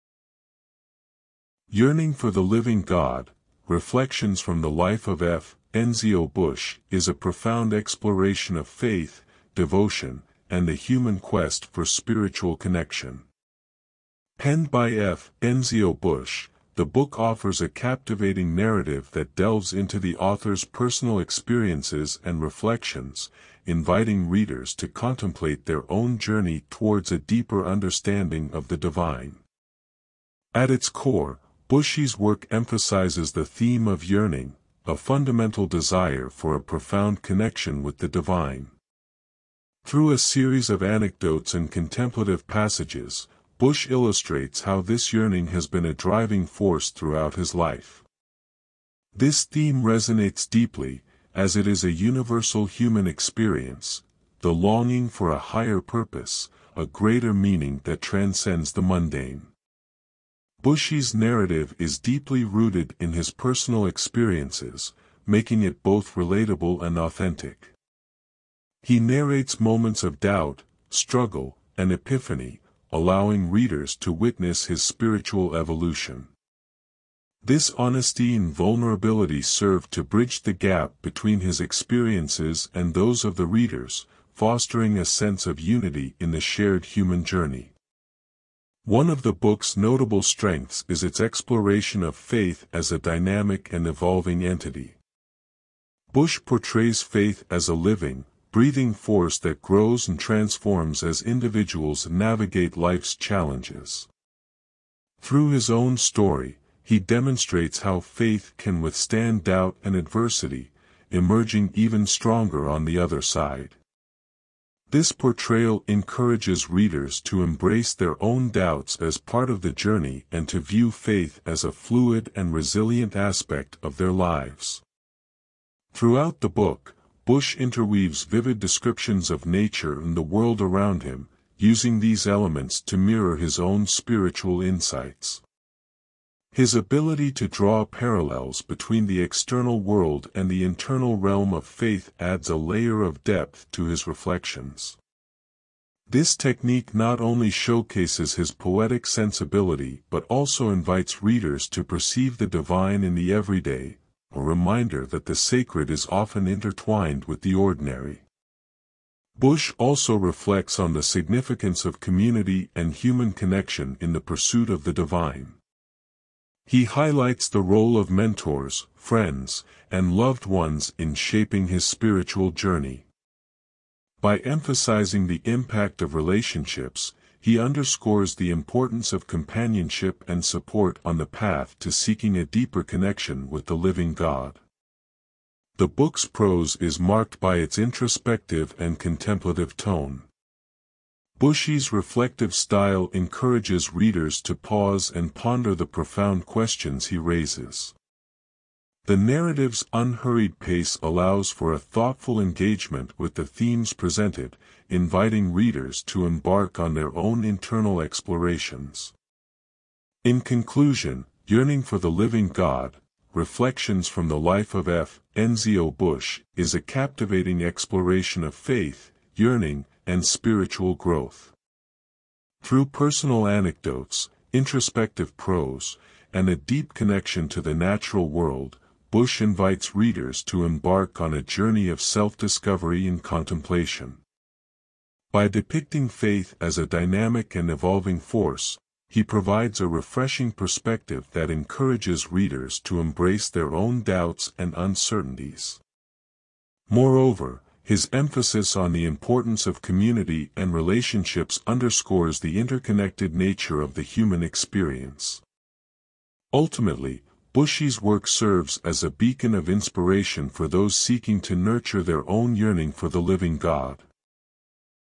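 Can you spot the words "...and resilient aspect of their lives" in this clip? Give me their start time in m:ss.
2:02.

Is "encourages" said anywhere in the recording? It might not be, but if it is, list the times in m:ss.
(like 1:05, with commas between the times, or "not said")
1:55, 3:13, 4:01.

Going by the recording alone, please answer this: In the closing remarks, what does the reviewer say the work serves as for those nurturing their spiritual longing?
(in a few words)
a beacon of inspiration.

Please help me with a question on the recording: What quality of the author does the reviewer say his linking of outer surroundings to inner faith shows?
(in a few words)
poetic sensibility.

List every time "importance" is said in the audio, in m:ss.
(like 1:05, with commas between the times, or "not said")
2:58, 4:09.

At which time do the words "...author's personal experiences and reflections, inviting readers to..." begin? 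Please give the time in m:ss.
0:20.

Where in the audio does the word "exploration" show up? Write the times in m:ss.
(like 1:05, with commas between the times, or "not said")
0:07, 1:31, 3:28, 3:37.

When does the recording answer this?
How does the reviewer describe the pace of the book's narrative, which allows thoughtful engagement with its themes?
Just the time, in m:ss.
3:19.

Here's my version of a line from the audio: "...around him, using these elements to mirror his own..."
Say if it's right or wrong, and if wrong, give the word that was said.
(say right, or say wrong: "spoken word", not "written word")
right.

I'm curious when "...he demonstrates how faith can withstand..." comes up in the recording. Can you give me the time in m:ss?
1:46.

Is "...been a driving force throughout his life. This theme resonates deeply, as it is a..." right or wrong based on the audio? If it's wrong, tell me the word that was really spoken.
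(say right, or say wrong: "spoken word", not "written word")
right.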